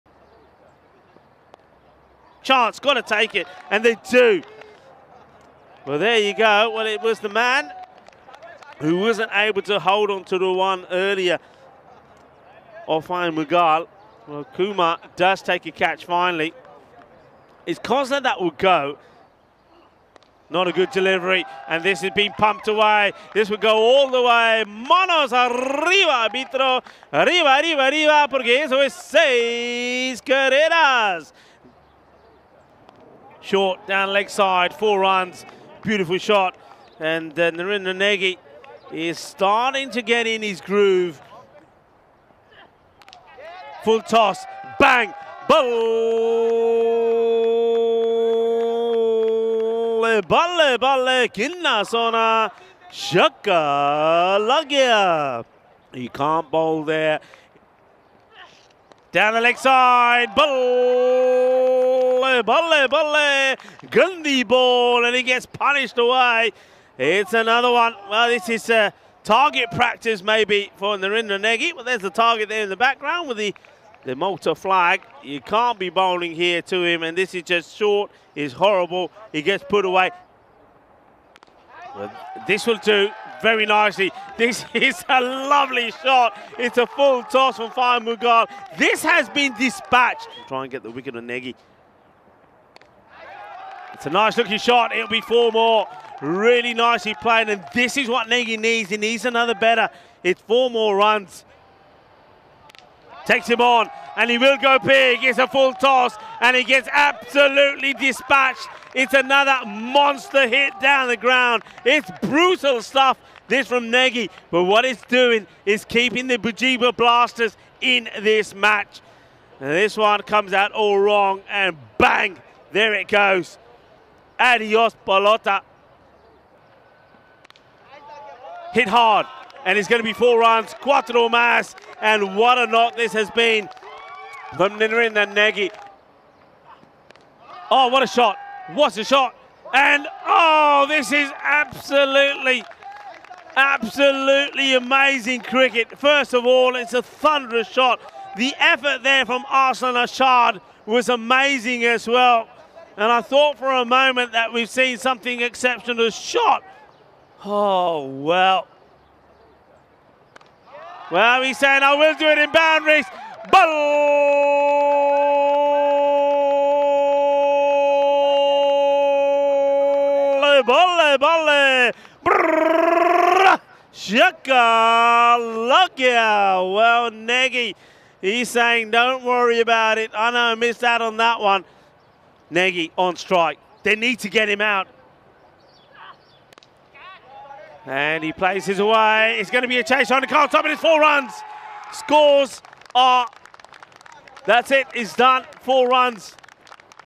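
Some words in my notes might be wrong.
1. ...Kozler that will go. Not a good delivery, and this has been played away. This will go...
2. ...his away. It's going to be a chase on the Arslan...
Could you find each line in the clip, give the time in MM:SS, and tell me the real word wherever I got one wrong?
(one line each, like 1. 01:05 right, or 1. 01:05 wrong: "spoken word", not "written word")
1. 00:17 wrong: "pumped", not "played"
2. 03:08 wrong: "Top", not "Arslan".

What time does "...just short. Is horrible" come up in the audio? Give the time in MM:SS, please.
01:17.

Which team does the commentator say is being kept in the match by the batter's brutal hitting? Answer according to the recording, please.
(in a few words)
Bugibba Blasters.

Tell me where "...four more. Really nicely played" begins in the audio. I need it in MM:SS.
01:35.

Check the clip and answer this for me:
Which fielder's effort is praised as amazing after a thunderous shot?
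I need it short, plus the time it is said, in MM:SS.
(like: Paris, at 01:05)
Arslan Ashad, at 02:29.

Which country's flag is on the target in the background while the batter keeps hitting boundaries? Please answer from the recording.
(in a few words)
Malta.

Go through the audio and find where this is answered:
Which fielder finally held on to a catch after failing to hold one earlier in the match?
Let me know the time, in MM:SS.
00:14.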